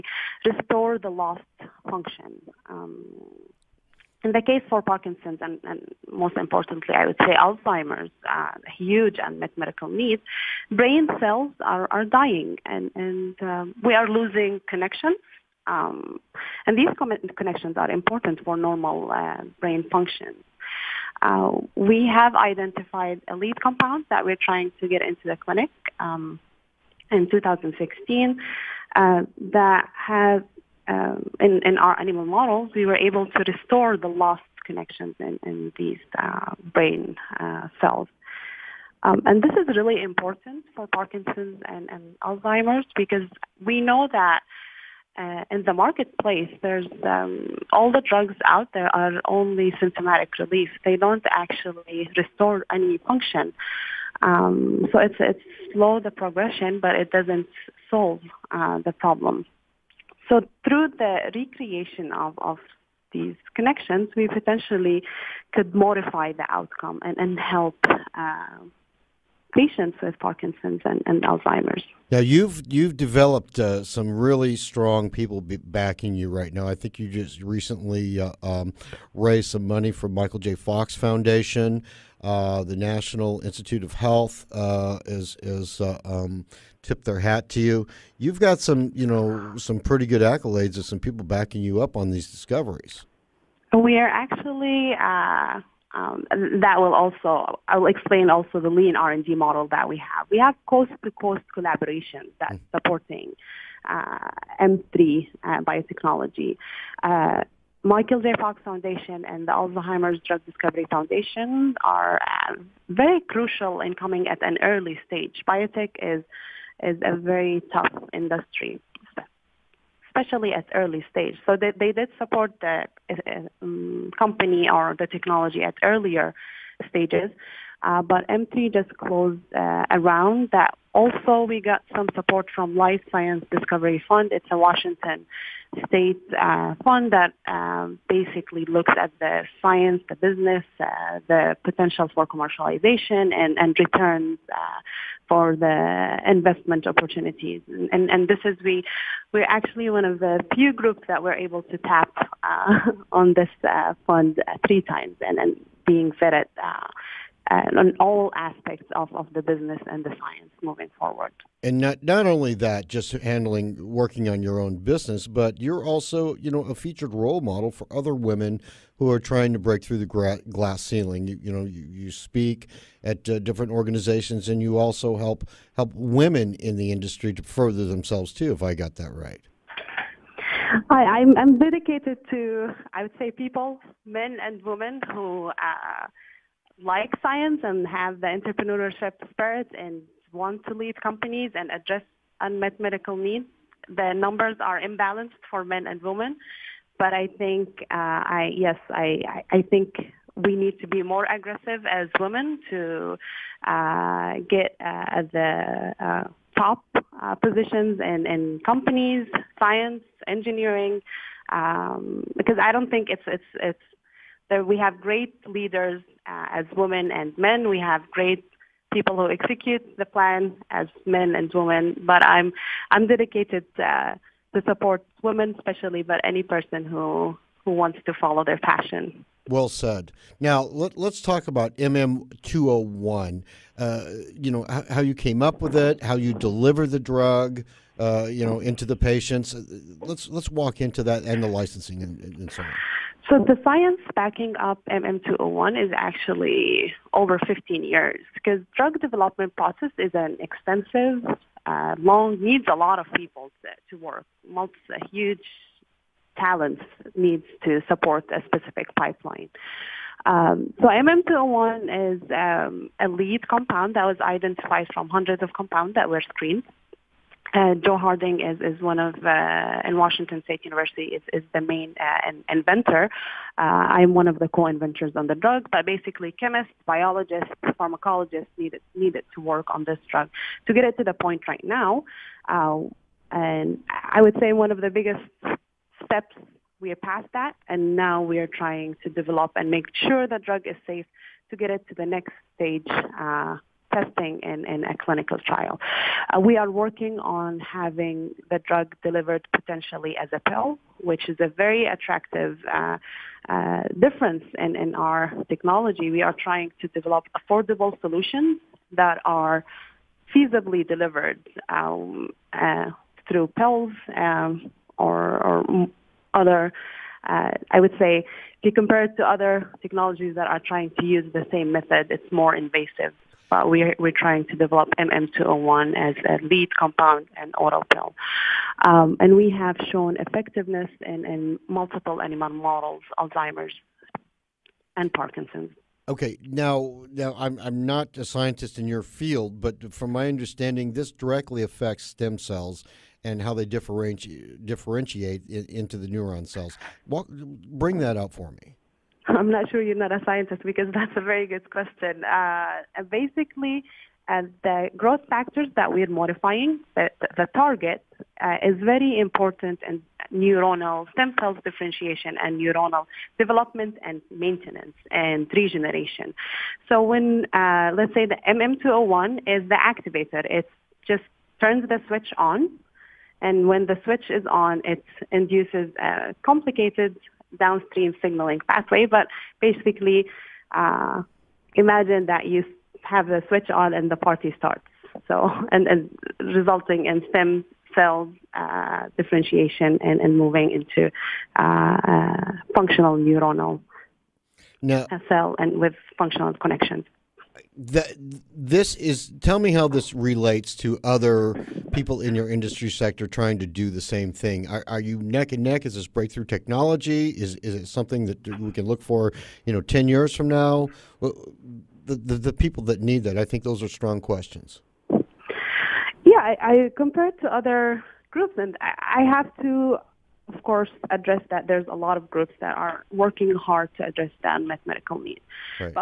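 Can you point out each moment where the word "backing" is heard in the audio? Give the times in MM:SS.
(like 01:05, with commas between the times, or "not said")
01:15, 01:31, 04:04.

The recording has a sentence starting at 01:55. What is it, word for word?
Biotech is is a very tough industry, especially at early stage.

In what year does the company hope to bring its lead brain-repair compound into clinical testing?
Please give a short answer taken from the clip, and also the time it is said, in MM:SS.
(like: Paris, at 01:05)
2016, at 00:27.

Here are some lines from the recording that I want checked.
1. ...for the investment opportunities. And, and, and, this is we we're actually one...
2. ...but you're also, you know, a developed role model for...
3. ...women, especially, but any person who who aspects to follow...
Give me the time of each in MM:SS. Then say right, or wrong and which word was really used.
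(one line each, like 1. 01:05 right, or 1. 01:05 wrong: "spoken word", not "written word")
1. 02:25 right
2. 02:45 wrong: "featured", not "developed"
3. 03:45 wrong: "wants", not "aspects".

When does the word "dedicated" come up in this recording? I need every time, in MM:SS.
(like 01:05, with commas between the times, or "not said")
03:01, 03:43.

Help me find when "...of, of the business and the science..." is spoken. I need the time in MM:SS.
02:38.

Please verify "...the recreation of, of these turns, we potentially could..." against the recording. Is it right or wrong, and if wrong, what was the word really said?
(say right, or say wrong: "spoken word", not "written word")
wrong: "connections", not "turns".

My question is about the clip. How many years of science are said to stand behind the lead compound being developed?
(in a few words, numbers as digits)
15.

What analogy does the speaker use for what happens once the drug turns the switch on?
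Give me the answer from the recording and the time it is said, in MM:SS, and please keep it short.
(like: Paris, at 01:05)
The party starts, at 06:24.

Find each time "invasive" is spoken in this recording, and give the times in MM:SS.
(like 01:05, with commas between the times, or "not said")
05:22.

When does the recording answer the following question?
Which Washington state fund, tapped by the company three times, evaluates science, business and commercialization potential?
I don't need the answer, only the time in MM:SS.
02:12.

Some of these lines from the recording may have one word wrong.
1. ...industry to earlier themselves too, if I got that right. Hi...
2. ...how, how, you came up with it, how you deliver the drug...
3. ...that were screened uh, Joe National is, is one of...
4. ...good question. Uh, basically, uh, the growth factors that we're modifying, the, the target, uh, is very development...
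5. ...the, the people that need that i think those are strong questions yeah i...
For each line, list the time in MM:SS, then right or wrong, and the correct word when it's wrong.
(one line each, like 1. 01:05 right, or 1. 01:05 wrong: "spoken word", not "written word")
1. 02:56 wrong: "further", not "earlier"
2. 03:54 right
3. 04:25 wrong: "Harding", not "National"
4. 05:51 wrong: "important", not "development"
5. 06:52 right.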